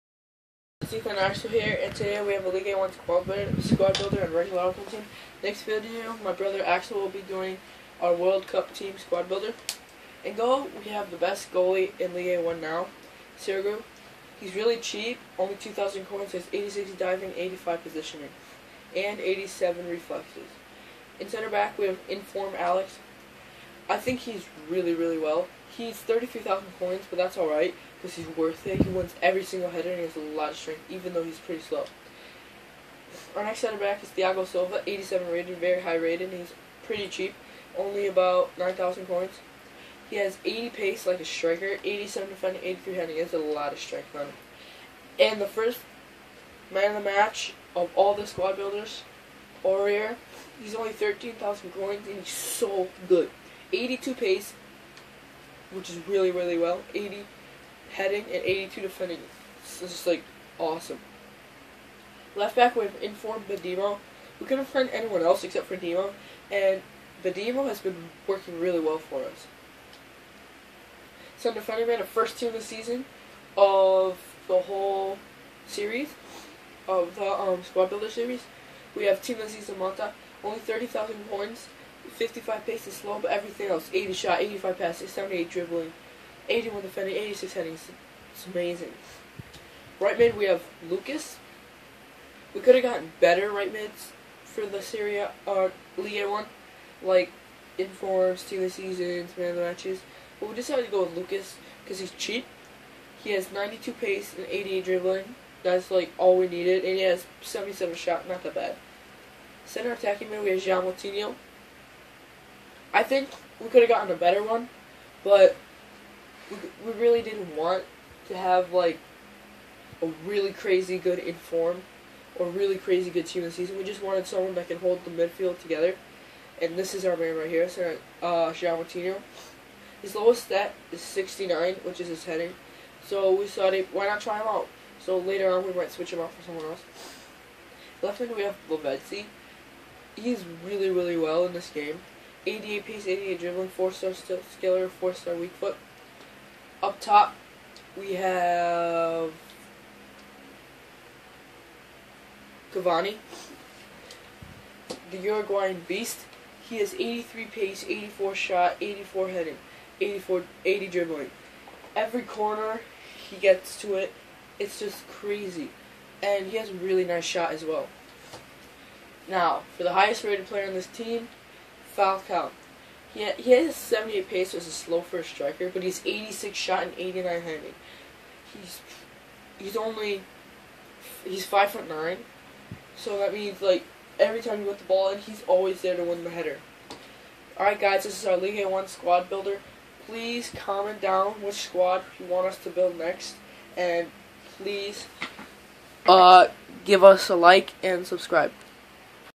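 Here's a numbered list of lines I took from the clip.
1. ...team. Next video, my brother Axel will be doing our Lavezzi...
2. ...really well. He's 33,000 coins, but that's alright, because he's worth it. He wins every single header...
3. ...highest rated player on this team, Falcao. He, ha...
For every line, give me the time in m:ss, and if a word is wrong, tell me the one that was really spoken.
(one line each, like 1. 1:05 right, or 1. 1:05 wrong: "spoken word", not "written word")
1. 0:04 wrong: "World", not "Lavezzi"
2. 0:24 right
3. 2:49 right.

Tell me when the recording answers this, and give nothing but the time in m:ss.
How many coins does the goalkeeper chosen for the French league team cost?
0:15.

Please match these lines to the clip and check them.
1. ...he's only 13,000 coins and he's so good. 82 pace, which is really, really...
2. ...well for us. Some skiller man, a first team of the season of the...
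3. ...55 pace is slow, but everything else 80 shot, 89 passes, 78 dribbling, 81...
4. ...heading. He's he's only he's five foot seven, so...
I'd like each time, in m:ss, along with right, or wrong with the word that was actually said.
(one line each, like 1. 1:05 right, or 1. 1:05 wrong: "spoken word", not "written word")
1. 0:50 right
2. 1:08 wrong: "defender", not "skiller"
3. 1:22 wrong: "85", not "89"
4. 2:57 wrong: "nine", not "seven".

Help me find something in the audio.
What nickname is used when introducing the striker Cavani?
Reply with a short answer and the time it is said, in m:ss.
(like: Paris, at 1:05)
Uruguayan beast, at 2:35.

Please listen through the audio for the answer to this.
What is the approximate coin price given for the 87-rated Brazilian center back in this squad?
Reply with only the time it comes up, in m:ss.
0:38.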